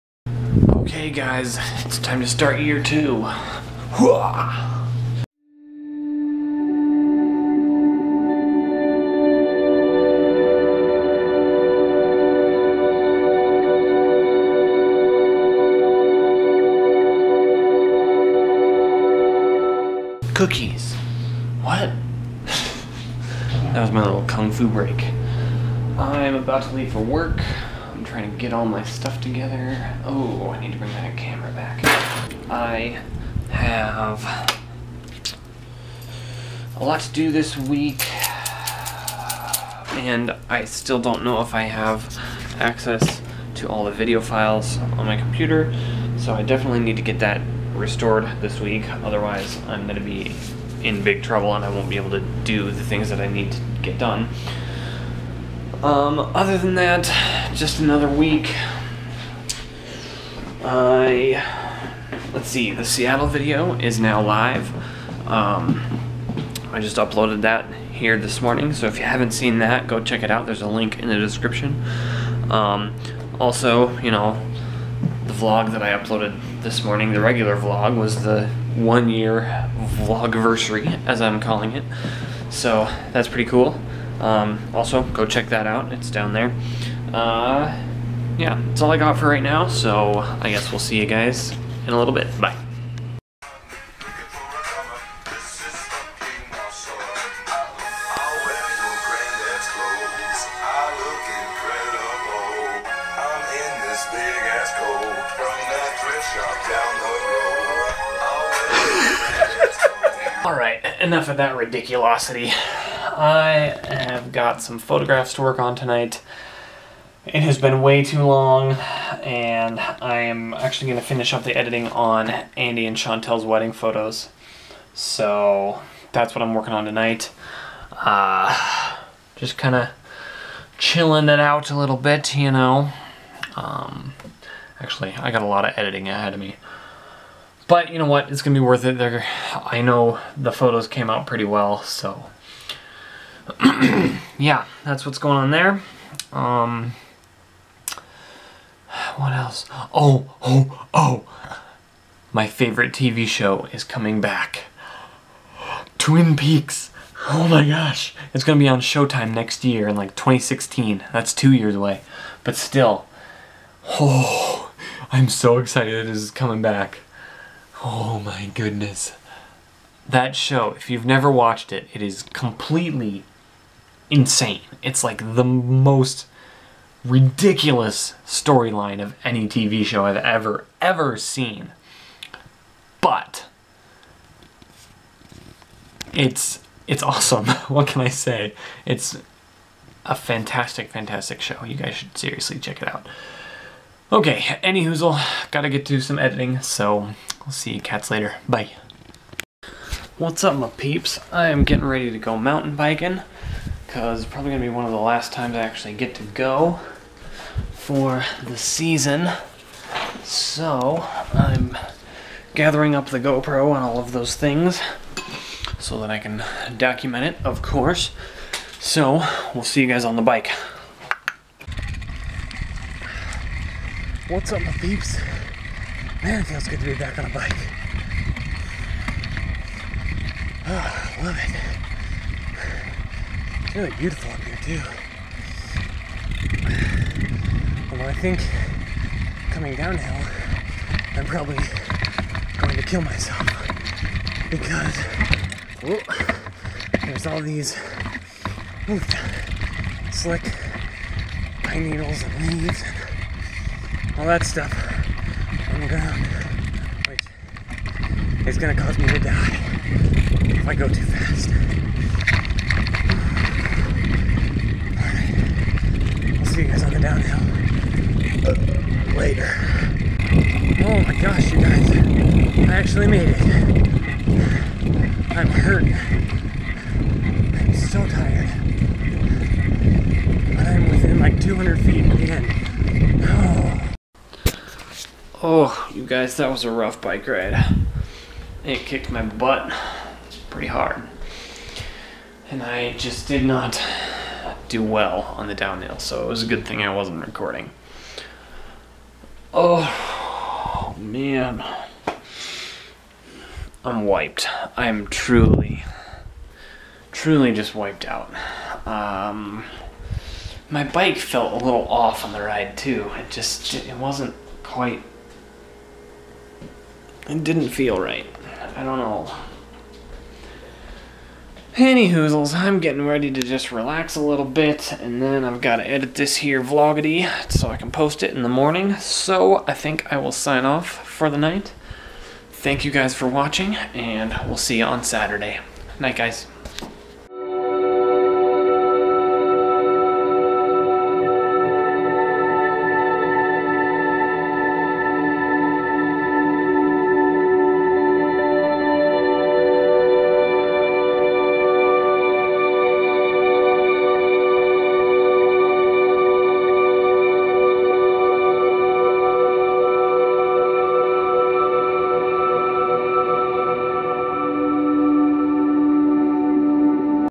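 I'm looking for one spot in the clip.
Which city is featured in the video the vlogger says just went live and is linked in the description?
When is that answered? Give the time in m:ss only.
1:02.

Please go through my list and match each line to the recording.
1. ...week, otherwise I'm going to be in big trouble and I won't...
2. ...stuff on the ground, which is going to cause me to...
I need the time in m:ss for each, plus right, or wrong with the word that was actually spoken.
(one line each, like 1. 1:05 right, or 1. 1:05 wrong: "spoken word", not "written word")
1. 0:48 right
2. 4:14 right.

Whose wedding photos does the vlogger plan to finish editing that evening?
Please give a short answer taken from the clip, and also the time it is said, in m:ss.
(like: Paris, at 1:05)
Andy and Chantel, at 2:02.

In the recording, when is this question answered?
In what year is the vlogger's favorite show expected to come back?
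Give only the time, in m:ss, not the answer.
2:40.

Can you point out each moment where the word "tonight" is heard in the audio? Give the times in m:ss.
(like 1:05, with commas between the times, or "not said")
1:55, 2:06.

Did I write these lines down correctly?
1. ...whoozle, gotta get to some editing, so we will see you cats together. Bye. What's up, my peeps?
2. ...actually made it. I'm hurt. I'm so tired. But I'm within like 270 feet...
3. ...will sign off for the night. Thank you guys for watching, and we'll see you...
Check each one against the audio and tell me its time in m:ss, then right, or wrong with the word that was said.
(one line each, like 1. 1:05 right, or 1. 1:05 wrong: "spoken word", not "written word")
1. 3:14 wrong: "later", not "together"
2. 4:32 wrong: "200", not "270"
3. 5:30 right.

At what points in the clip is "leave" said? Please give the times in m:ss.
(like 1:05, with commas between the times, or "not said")
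0:26, 4:12.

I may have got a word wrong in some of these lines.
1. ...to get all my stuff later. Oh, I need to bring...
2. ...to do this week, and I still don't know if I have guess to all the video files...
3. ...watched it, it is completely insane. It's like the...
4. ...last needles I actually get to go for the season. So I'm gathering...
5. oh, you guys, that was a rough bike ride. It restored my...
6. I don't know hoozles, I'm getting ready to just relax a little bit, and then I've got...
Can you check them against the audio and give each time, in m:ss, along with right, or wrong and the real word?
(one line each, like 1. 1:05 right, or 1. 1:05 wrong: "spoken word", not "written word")
1. 0:28 wrong: "together", not "later"
2. 0:37 wrong: "access", not "guess"
3. 2:51 right
4. 3:24 wrong: "times", not "needles"
5. 4:45 wrong: "kicked", not "restored"
6. 5:18 right.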